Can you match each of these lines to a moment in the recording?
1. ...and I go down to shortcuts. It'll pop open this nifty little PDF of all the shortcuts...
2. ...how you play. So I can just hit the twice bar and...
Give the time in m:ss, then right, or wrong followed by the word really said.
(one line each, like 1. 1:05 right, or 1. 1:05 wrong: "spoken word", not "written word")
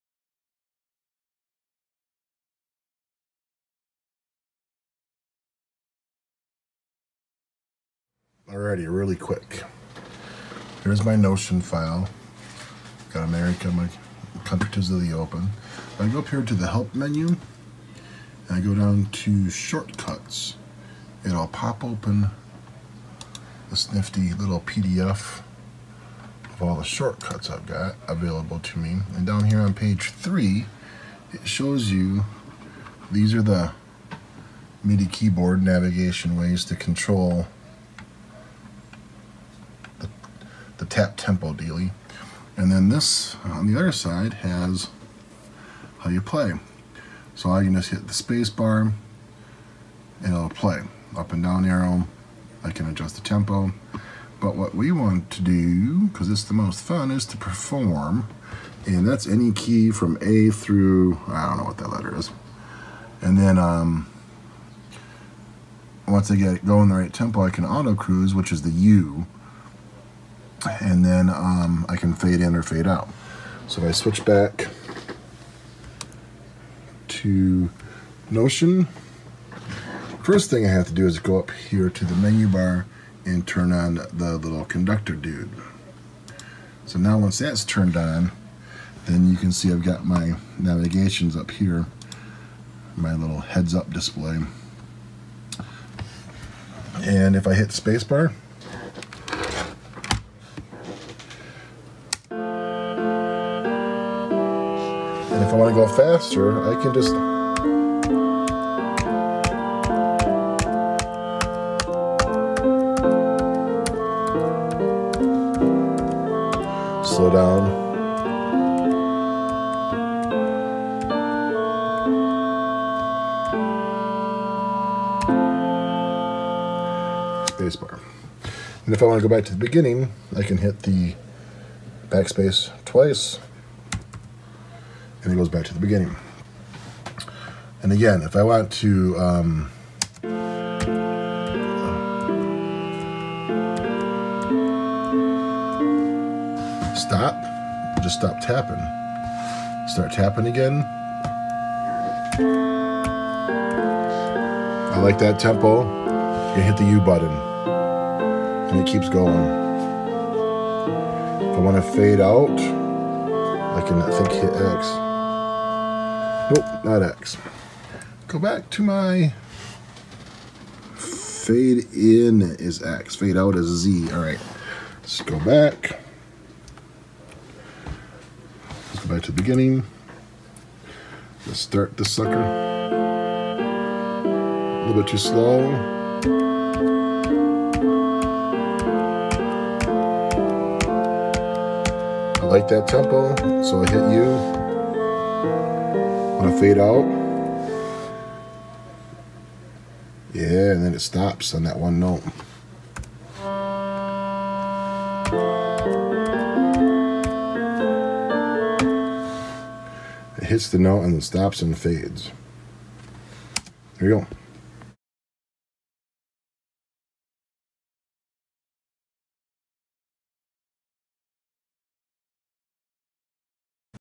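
1. 0:17 right
2. 0:45 wrong: "space", not "twice".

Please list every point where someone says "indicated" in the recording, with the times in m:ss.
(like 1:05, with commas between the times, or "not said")
not said.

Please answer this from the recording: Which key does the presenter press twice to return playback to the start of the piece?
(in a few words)
Backspace.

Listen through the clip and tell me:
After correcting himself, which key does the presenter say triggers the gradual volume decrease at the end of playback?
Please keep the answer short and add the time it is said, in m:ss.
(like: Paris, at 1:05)
Z, at 2:53.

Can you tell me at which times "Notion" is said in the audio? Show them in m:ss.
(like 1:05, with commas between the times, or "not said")
0:11, 1:18.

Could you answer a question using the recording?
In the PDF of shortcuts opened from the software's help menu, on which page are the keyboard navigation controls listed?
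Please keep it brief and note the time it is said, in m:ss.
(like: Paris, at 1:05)
3, at 0:30.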